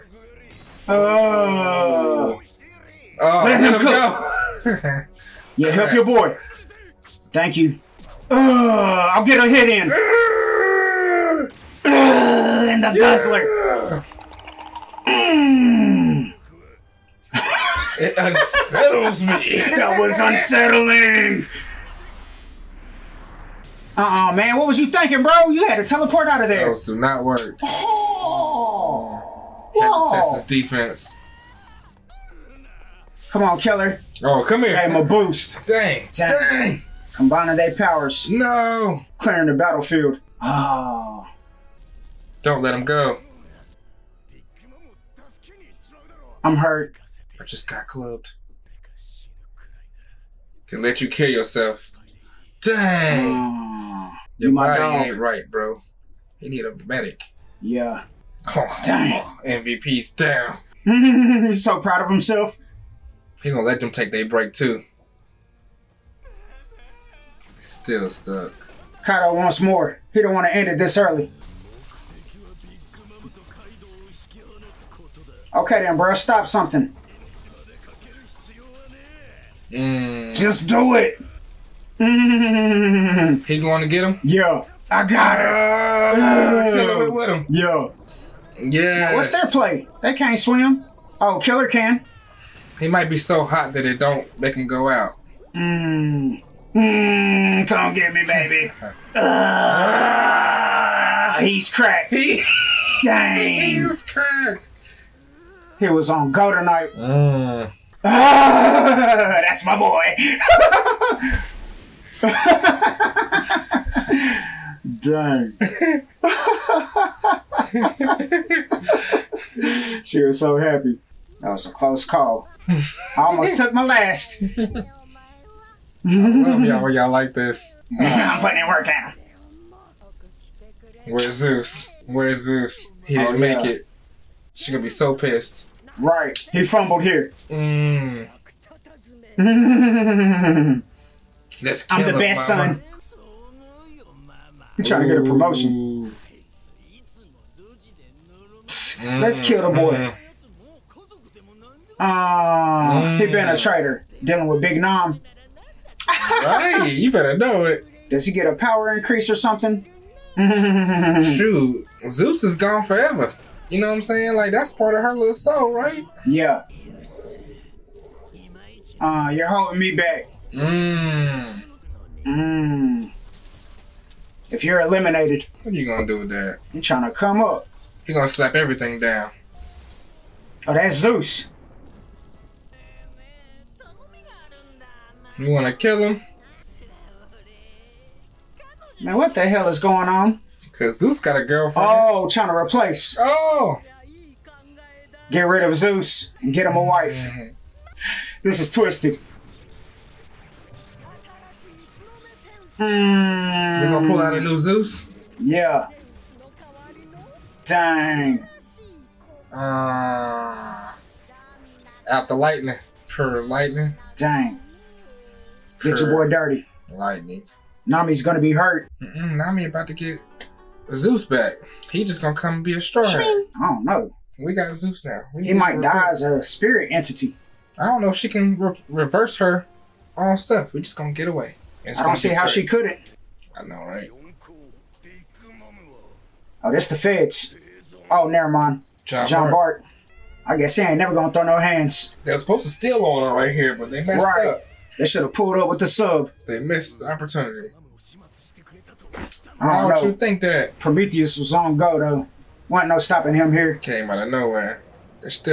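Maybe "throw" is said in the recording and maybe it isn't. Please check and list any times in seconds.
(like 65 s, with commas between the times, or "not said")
241 s.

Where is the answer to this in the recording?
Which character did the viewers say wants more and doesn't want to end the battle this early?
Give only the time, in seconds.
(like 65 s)
69 s.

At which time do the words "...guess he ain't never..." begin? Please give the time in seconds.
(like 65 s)
240 s.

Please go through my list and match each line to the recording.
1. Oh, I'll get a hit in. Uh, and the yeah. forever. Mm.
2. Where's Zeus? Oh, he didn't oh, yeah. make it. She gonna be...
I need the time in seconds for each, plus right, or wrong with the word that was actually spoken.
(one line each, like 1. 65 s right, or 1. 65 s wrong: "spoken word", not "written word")
1. 8 s wrong: "guzzler", not "forever"
2. 132 s right.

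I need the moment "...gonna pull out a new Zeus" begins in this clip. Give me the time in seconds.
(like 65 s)
203 s.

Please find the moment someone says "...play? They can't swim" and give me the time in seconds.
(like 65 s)
89 s.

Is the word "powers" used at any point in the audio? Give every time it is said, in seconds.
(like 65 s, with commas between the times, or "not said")
37 s, 158 s.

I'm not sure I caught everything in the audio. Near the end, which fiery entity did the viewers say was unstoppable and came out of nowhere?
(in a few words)
Prometheus.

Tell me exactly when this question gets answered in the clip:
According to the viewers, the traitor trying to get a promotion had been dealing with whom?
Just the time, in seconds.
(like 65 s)
154 s.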